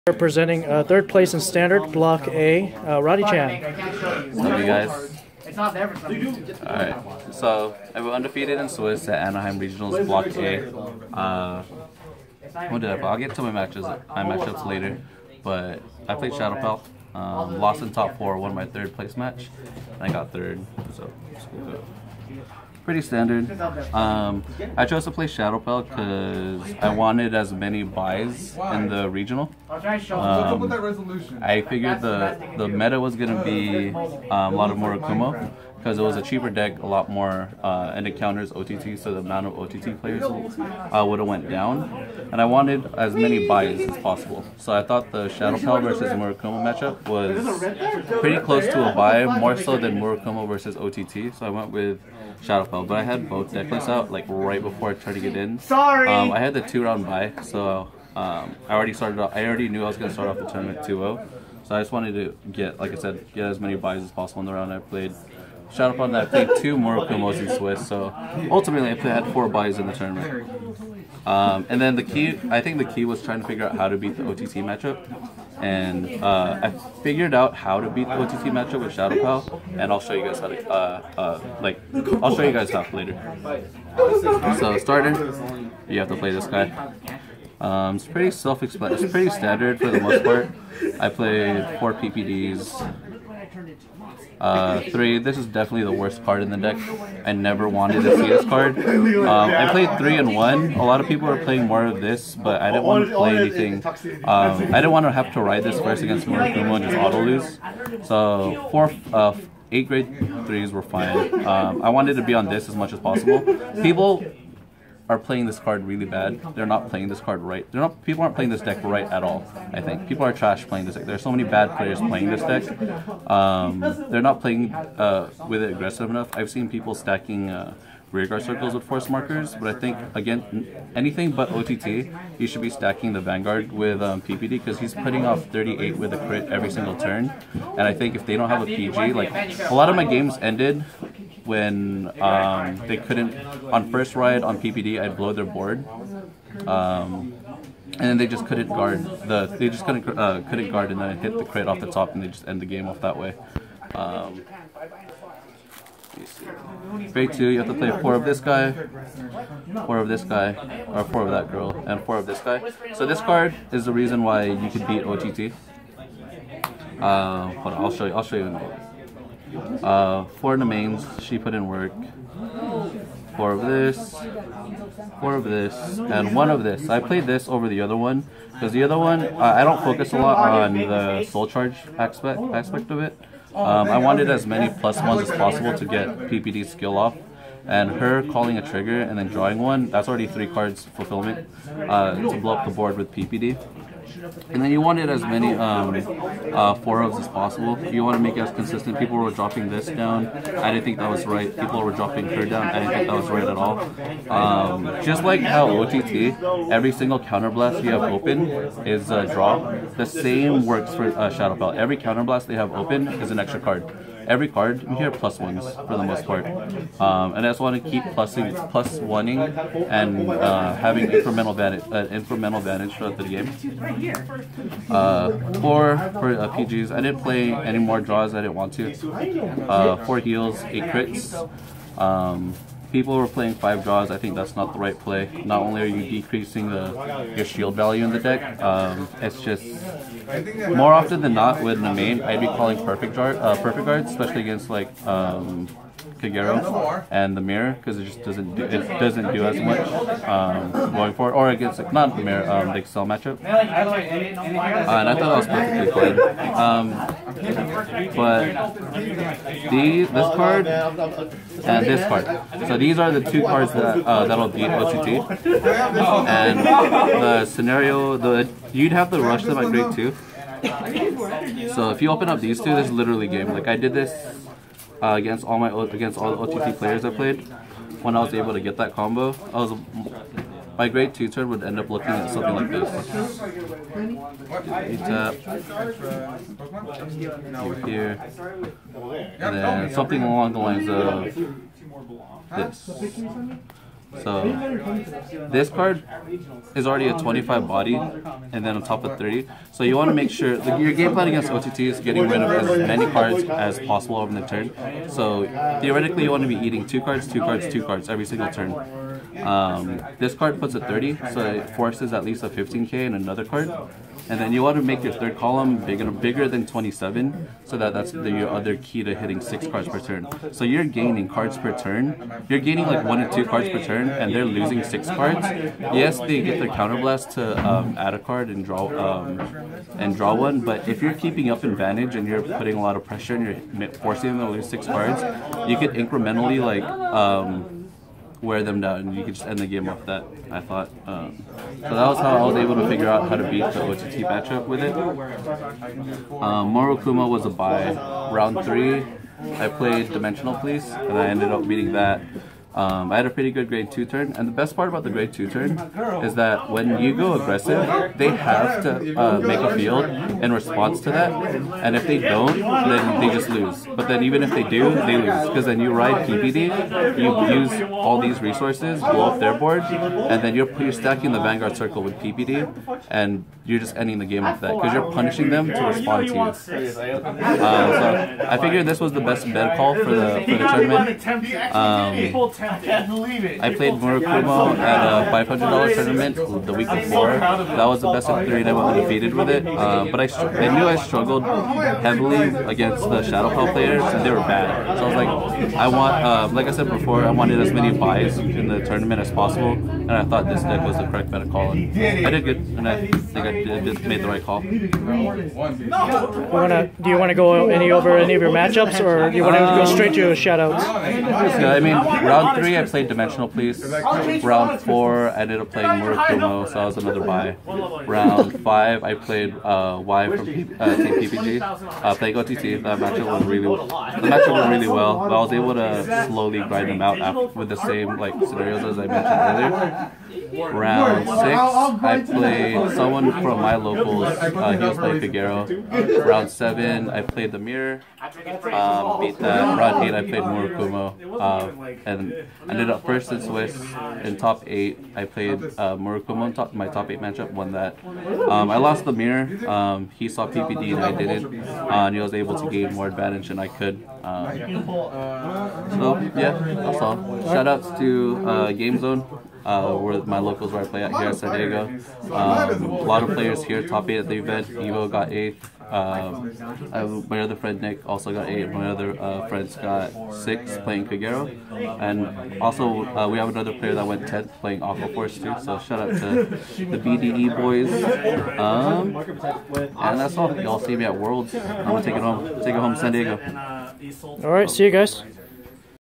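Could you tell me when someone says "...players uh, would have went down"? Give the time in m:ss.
0:39.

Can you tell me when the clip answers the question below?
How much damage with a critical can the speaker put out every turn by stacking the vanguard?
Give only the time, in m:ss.
2:15.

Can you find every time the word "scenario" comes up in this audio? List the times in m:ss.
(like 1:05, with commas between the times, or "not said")
4:27, 7:08.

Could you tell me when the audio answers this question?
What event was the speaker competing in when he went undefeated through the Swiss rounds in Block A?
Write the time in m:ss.
0:09.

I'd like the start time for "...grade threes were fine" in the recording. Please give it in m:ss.
1:49.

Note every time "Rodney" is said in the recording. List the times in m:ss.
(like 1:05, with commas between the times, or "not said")
0:03.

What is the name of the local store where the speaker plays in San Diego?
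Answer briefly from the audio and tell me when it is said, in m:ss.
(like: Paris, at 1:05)
Game Zone, at 7:38.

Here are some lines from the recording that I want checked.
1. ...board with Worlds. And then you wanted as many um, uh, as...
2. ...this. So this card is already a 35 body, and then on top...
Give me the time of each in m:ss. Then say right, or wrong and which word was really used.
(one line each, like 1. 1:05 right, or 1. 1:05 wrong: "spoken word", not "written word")
1. 3:12 wrong: "PPD", not "Worlds"
2. 4:52 wrong: "25", not "35".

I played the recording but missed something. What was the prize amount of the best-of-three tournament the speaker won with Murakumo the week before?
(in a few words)
$500.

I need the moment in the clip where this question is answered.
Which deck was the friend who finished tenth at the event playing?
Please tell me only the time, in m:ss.
7:54.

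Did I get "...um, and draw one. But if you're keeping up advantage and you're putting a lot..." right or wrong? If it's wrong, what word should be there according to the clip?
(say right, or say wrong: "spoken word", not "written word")
right.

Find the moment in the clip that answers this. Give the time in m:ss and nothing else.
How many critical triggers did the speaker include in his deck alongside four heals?
3:50.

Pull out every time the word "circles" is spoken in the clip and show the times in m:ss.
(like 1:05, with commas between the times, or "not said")
2:08, 6:11.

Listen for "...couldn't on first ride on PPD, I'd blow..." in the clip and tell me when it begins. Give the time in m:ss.
2:22.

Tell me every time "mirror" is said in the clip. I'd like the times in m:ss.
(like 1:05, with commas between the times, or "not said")
4:07, 4:12, 7:17, 7:29.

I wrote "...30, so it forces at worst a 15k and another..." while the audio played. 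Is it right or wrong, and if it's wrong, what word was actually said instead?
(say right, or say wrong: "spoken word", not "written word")
wrong: "least", not "worst".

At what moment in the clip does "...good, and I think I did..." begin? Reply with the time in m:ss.
6:42.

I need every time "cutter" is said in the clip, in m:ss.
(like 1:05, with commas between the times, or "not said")
not said.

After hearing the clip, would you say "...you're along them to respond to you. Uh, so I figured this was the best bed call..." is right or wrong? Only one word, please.
wrong.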